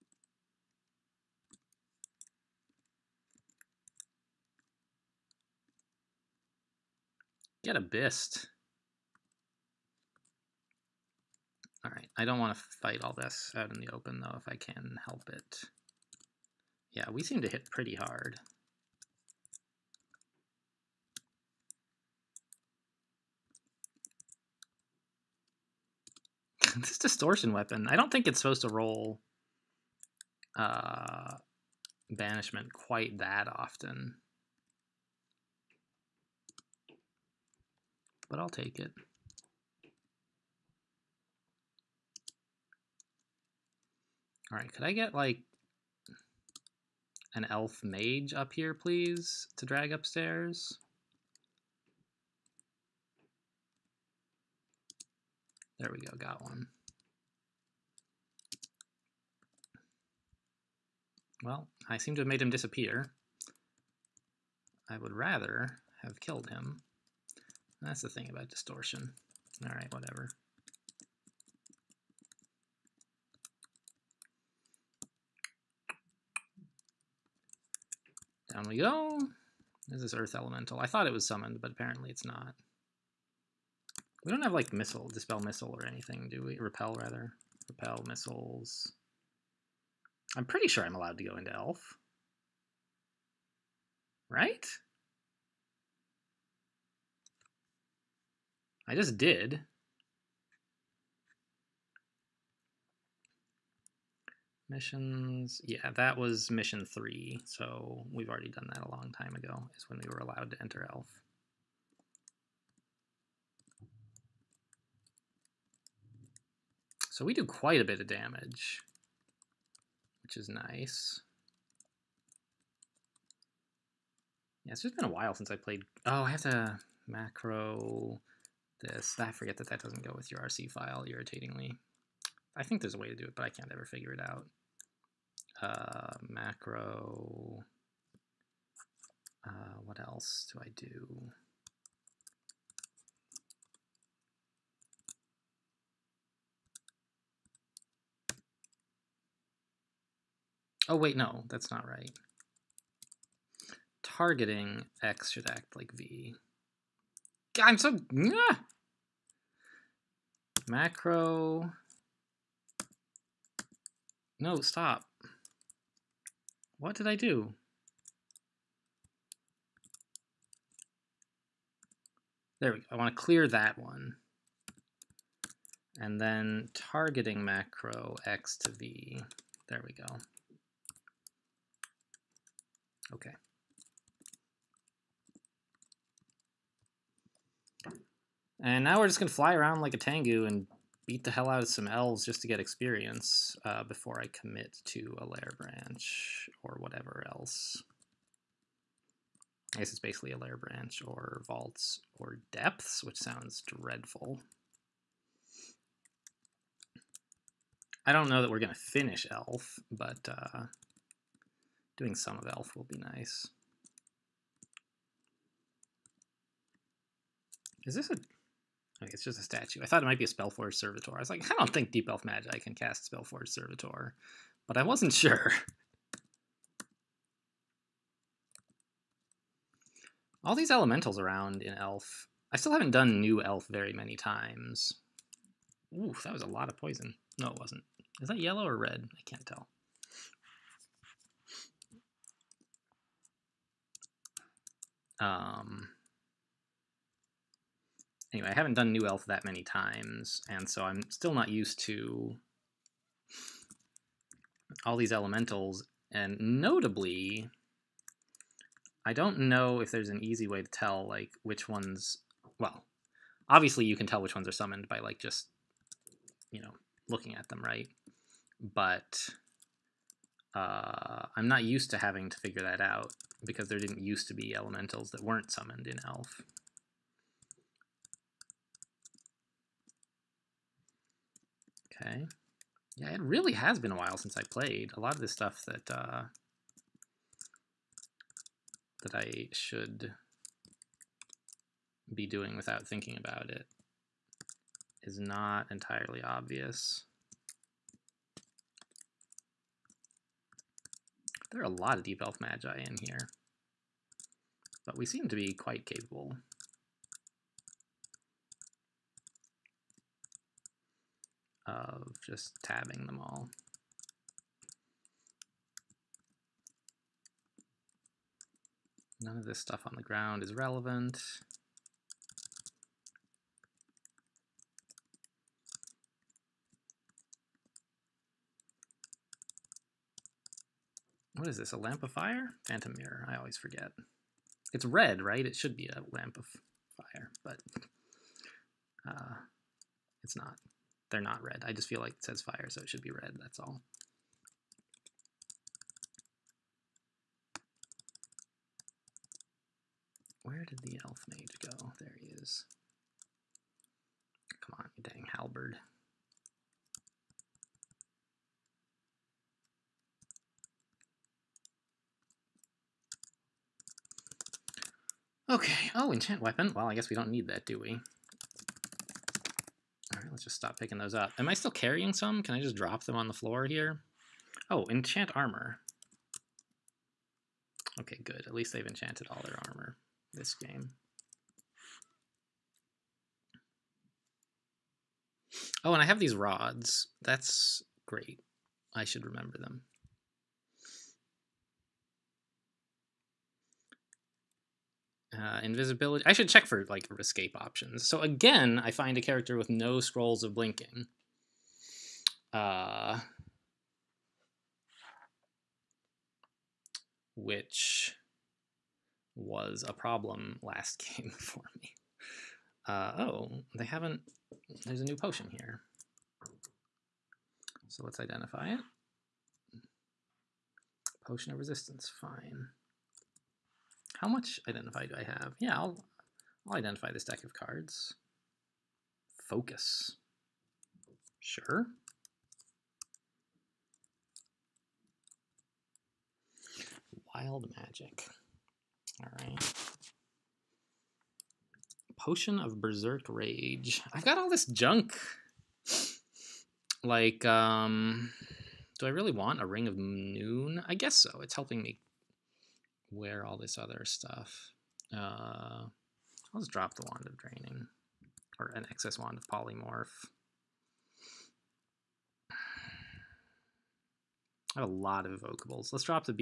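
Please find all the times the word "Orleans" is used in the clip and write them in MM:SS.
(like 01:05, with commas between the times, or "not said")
not said.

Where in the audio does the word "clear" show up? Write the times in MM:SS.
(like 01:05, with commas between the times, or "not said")
02:53.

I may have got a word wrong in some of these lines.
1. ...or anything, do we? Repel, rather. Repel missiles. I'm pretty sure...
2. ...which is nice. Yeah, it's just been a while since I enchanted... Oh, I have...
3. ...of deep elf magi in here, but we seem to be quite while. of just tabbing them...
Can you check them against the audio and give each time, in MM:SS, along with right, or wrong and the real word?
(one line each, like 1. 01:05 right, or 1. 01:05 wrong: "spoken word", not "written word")
1. 01:25 right
2. 02:00 wrong: "played", not "enchanted"
3. 05:01 wrong: "capable", not "while".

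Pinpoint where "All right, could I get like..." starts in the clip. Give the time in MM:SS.
00:44.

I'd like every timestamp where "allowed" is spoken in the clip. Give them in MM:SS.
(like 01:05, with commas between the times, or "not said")
01:30, 01:50.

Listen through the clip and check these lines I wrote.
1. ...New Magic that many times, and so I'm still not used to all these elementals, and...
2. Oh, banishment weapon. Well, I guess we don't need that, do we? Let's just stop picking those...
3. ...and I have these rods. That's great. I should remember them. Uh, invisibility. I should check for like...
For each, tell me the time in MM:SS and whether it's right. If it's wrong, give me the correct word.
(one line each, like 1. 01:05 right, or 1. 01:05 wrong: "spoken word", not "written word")
1. 04:08 wrong: "Elf", not "Magic"
2. 06:05 wrong: "enchant", not "banishment"
3. 06:25 right.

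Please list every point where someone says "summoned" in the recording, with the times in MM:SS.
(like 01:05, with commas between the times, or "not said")
01:21, 04:24, 04:35.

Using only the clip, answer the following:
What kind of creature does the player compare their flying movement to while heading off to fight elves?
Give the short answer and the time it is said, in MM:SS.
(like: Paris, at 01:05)
Tengu, at 03:09.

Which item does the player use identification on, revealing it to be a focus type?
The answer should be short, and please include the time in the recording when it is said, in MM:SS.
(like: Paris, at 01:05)
Deck of cards, at 07:07.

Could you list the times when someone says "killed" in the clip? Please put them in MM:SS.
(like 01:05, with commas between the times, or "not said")
01:06.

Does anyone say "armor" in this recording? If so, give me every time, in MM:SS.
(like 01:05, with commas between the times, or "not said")
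06:15, 06:19.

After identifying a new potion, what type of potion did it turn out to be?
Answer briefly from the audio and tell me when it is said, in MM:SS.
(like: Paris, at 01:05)
Resistance, at 07:01.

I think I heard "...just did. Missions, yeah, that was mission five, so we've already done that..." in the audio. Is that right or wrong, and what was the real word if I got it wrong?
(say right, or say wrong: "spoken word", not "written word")
wrong: "three", not "five".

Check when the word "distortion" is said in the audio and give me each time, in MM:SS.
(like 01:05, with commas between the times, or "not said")
00:26, 01:08.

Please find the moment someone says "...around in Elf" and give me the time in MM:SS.
03:51.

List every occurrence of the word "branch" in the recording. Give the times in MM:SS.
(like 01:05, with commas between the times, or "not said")
03:15, 03:20.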